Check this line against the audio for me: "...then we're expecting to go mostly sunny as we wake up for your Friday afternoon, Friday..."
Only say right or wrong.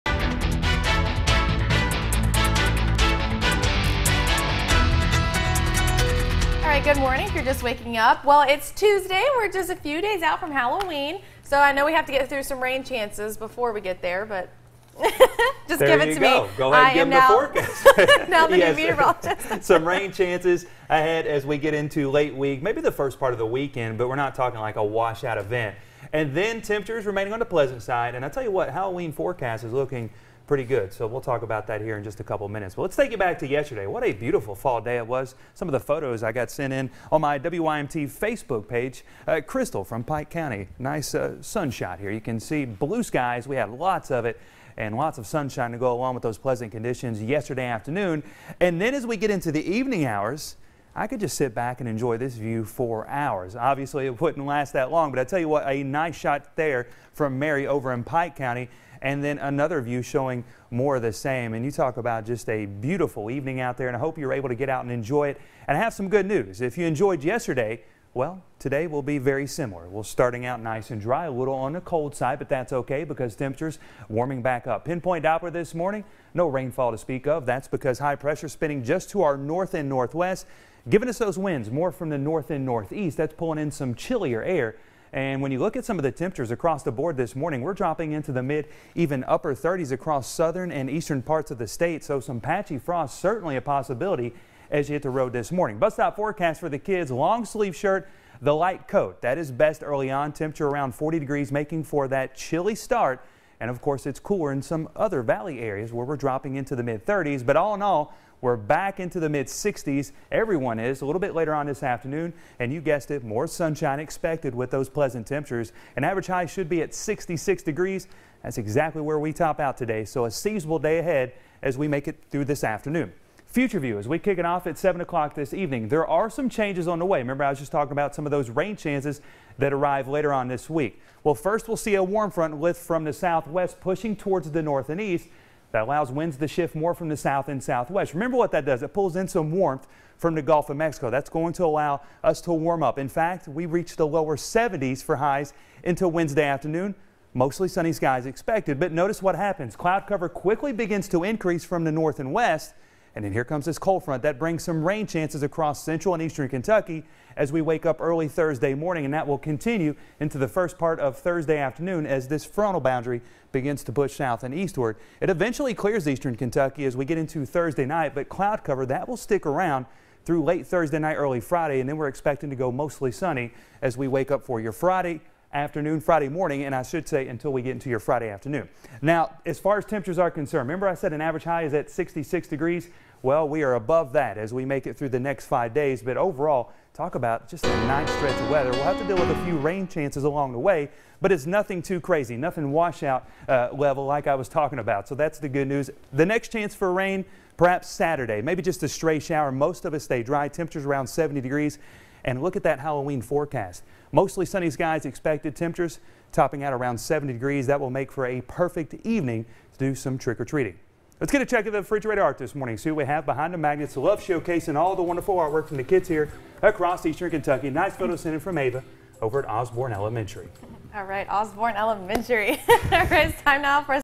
right.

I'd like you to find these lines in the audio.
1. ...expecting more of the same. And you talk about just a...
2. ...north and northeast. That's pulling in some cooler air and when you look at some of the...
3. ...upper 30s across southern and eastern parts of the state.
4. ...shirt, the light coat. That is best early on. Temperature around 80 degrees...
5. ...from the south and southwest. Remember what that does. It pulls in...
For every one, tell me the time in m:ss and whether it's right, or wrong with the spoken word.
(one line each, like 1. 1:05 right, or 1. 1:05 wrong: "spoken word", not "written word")
1. 1:00 wrong: "showing", not "expecting"
2. 1:22 wrong: "chillier", not "cooler"
3. 1:29 right
4. 1:37 wrong: "40", not "80"
5. 2:16 right.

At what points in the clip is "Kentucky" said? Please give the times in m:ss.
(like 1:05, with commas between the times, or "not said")
2:36, 2:46, 3:37.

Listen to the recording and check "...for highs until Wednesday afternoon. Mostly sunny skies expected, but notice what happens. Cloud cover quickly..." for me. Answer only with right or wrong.
right.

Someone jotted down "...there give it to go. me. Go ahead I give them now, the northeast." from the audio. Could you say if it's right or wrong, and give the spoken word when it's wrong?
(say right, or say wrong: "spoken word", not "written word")
wrong: "forecast", not "northeast".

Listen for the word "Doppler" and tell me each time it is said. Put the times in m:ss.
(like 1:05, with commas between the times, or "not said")
1:15.